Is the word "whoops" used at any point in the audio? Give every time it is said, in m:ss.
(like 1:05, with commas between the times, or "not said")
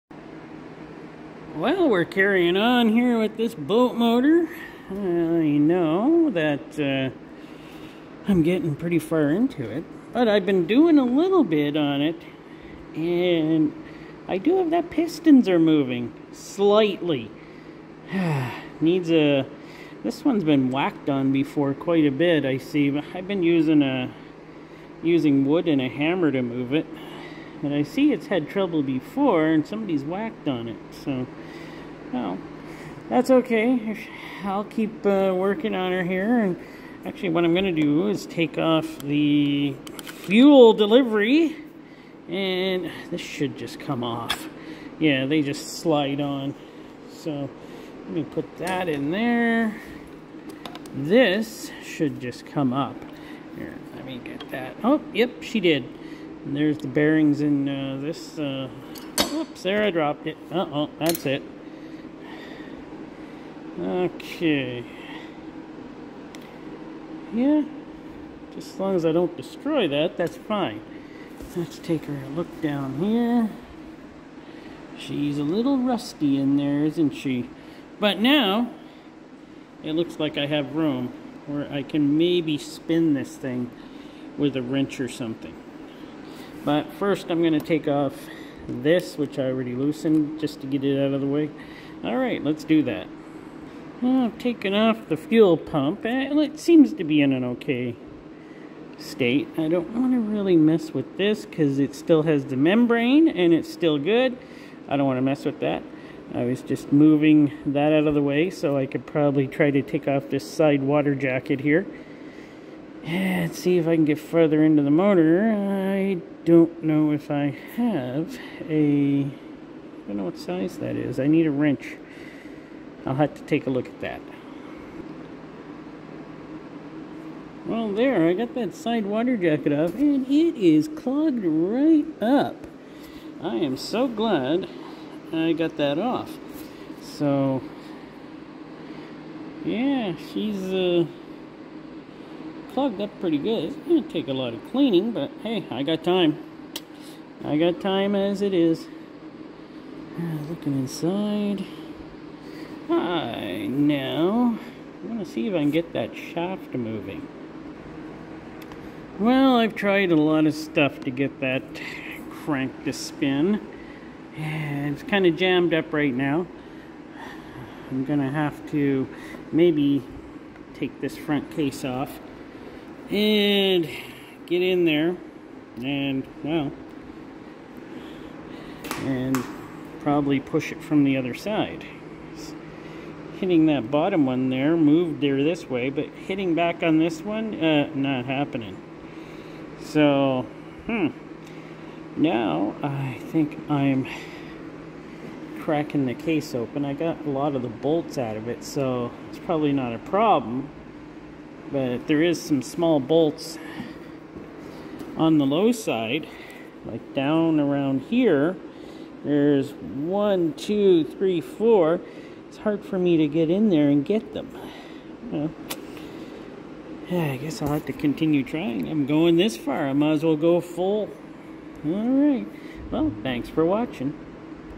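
0:59.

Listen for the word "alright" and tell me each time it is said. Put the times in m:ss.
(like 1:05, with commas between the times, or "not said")
1:32, 3:41.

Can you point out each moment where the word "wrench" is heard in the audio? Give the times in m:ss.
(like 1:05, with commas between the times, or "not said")
1:24, 2:01.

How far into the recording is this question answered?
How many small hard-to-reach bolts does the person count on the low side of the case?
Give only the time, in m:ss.
3:31.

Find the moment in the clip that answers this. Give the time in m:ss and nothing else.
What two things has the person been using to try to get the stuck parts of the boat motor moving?
0:25.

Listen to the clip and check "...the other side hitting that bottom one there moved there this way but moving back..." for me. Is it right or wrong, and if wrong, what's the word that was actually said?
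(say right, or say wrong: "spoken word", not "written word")
wrong: "hitting", not "moving".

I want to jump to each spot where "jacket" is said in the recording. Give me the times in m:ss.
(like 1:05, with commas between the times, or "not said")
1:51, 2:09.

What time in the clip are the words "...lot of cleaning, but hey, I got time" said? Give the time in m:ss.
2:24.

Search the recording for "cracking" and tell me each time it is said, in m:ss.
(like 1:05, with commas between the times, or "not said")
3:15.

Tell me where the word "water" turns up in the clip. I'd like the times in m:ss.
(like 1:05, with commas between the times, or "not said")
1:50, 2:09.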